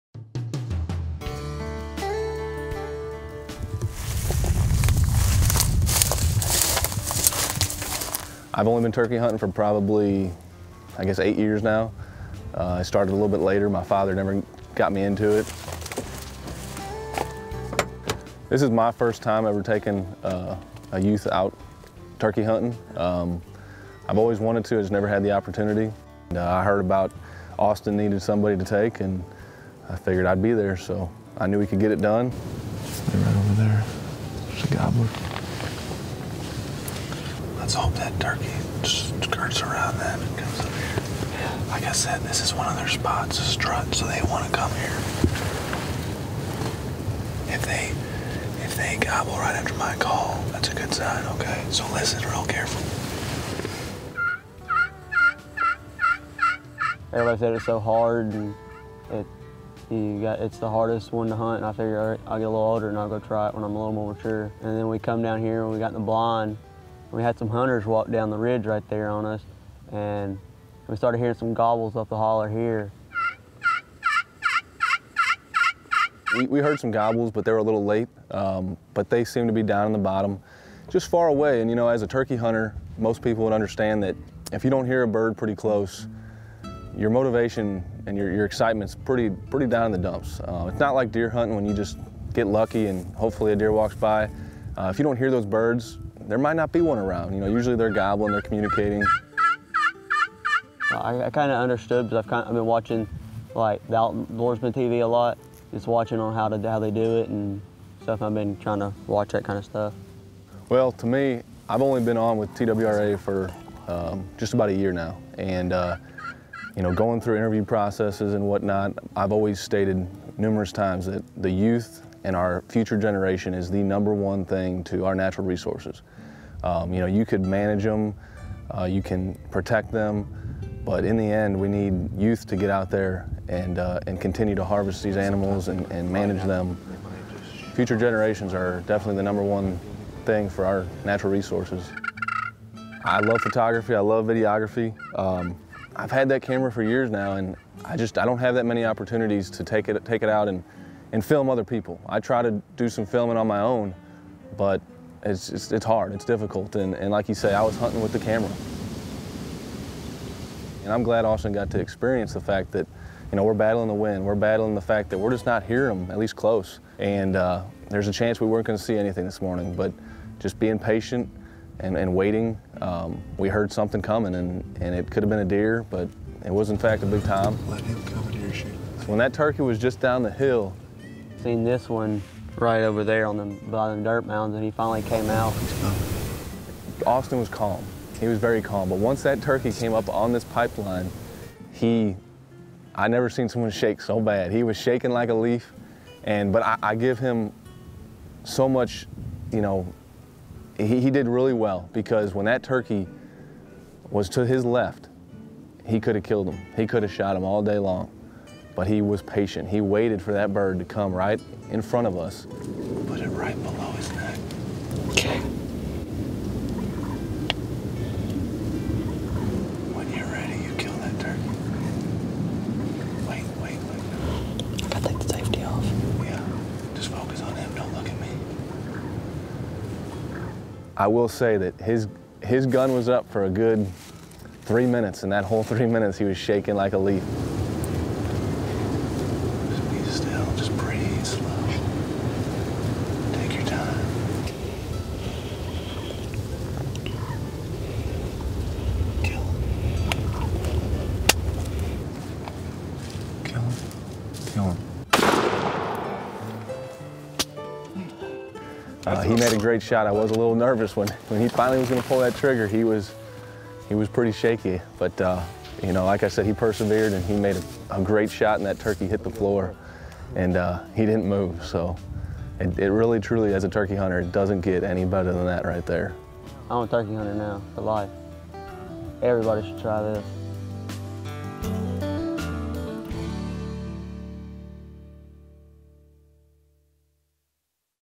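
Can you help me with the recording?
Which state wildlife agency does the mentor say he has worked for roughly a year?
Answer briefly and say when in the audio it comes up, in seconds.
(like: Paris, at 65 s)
TWRA, at 112 s.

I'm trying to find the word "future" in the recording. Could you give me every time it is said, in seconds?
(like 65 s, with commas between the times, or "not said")
122 s, 137 s.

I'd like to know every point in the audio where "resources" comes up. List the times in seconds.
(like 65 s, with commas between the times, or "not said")
125 s, 141 s.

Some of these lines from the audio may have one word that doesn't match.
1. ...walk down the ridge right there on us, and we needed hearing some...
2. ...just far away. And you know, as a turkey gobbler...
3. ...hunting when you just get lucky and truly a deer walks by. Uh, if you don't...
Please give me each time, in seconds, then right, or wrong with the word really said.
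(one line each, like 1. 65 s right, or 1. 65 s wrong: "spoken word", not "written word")
1. 67 s wrong: "started", not "needed"
2. 80 s wrong: "hunter", not "gobbler"
3. 91 s wrong: "hopefully", not "truly".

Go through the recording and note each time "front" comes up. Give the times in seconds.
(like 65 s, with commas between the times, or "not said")
211 s.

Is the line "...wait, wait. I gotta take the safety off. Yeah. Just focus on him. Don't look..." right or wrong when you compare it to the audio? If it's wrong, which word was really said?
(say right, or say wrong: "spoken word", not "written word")
right.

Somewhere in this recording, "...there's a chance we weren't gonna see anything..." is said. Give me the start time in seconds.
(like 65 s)
167 s.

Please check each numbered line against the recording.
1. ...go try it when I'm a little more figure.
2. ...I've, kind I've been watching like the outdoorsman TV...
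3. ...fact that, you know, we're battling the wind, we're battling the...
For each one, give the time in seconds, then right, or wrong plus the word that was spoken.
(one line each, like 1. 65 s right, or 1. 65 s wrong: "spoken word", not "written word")
1. 63 s wrong: "mature", not "figure"
2. 102 s right
3. 162 s right.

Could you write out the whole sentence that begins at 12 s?
Uh, I started a little bit later.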